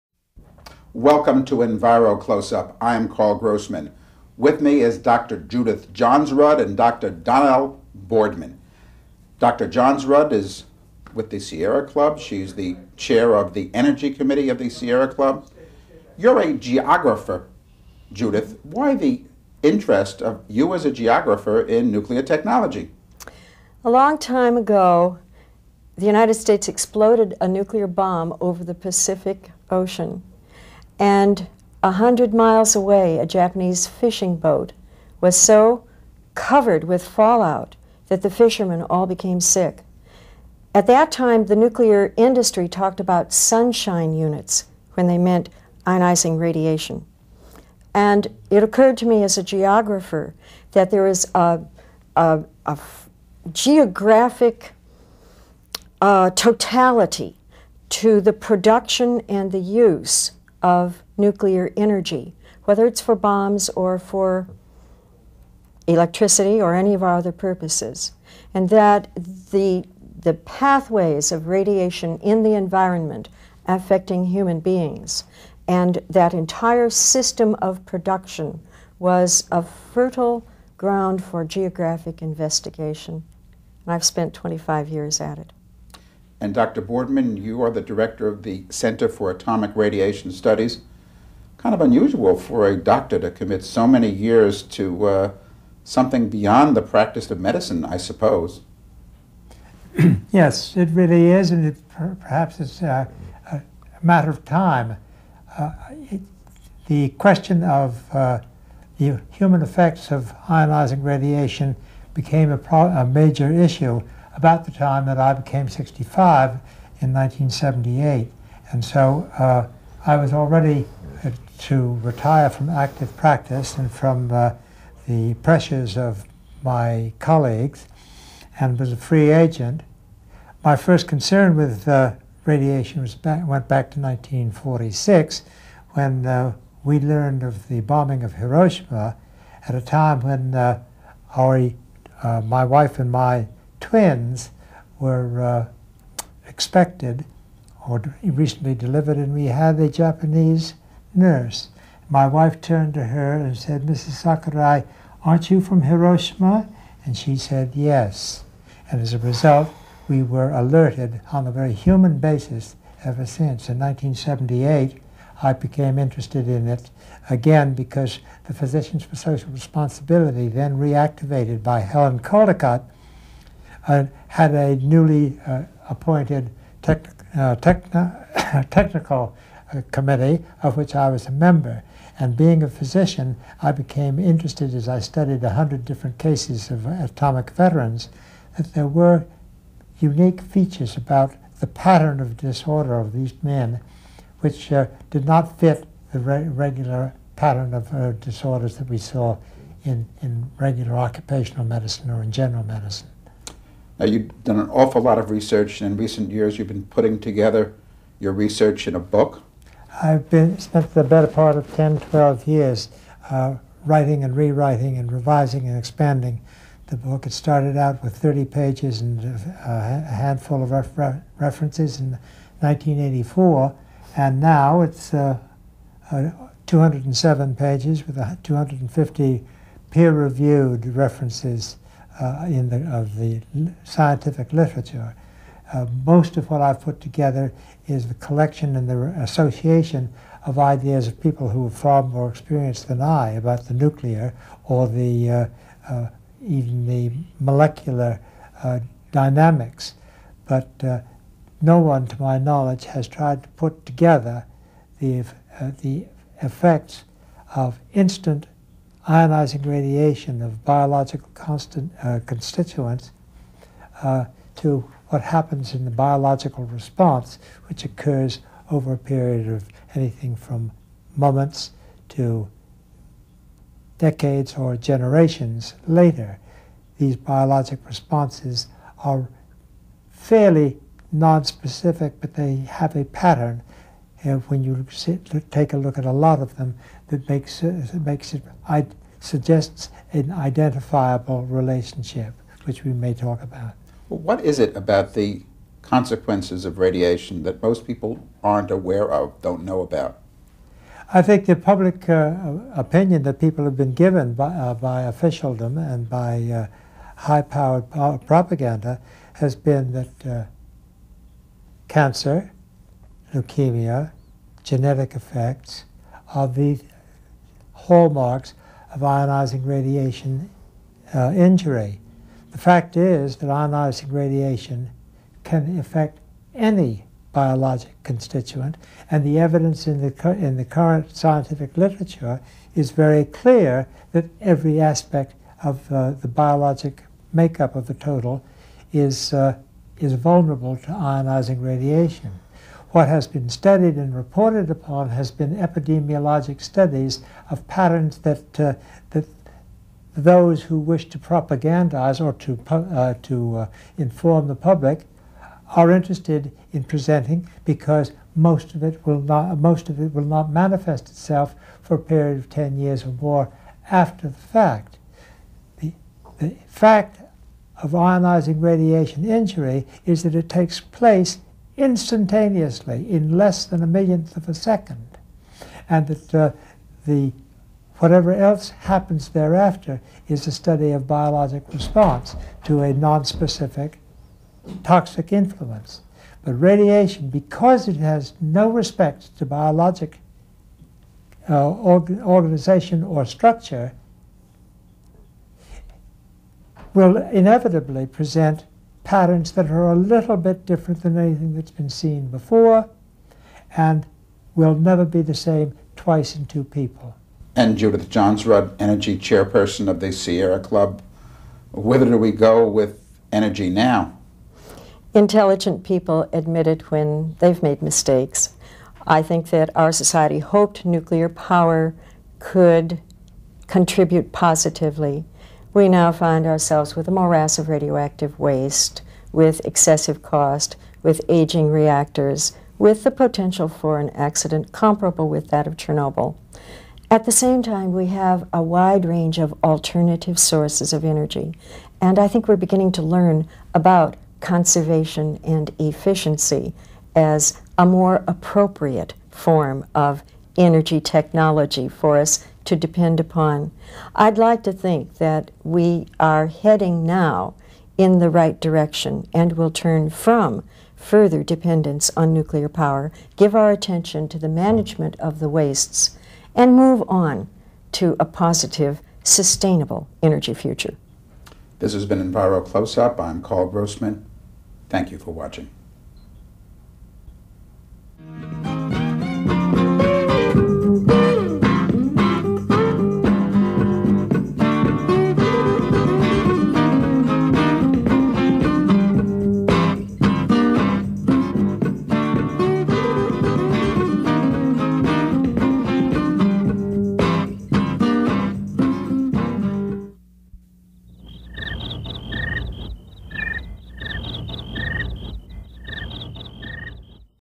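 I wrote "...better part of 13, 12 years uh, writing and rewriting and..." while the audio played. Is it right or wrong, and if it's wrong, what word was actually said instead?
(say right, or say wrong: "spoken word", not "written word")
wrong: "10", not "13".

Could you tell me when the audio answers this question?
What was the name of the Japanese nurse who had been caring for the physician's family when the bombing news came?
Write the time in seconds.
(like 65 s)
153 s.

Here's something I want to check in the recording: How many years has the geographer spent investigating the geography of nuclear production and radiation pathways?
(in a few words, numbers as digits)
25.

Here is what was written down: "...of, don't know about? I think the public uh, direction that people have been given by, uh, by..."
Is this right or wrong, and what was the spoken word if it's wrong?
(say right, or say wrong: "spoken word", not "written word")
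wrong: "opinion", not "direction".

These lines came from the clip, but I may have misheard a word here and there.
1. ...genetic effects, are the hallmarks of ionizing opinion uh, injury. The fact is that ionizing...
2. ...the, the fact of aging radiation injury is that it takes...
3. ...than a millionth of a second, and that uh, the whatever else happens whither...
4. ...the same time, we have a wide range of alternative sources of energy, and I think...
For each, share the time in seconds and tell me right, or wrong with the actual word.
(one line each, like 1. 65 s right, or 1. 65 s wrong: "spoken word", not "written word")
1. 314 s wrong: "radiation", not "opinion"
2. 365 s wrong: "ionizing", not "aging"
3. 373 s wrong: "thereafter", not "whither"
4. 437 s right.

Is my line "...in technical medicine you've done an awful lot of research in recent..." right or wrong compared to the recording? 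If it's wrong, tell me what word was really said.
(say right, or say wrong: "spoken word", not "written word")
wrong: "general", not "technical".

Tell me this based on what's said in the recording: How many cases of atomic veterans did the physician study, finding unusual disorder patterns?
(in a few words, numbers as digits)
100.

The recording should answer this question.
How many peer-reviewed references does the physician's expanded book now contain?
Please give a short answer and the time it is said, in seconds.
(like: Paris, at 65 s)
250, at 228 s.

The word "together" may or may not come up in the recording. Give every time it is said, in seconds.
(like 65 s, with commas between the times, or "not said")
207 s, 236 s, 253 s.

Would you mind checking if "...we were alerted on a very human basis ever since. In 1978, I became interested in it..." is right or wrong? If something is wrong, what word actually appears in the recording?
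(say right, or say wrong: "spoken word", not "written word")
right.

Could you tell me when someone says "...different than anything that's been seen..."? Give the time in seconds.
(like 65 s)
400 s.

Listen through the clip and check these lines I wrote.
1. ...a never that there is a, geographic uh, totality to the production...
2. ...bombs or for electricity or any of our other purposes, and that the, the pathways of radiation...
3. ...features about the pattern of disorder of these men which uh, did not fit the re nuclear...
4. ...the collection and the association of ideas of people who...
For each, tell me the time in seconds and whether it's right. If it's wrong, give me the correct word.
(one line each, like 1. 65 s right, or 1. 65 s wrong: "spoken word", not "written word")
1. 49 s wrong: "geographer", not "never"
2. 63 s right
3. 190 s wrong: "regular", not "nuclear"
4. 238 s right.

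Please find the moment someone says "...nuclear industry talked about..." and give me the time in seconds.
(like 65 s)
41 s.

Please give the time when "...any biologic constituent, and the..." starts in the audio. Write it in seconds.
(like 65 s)
326 s.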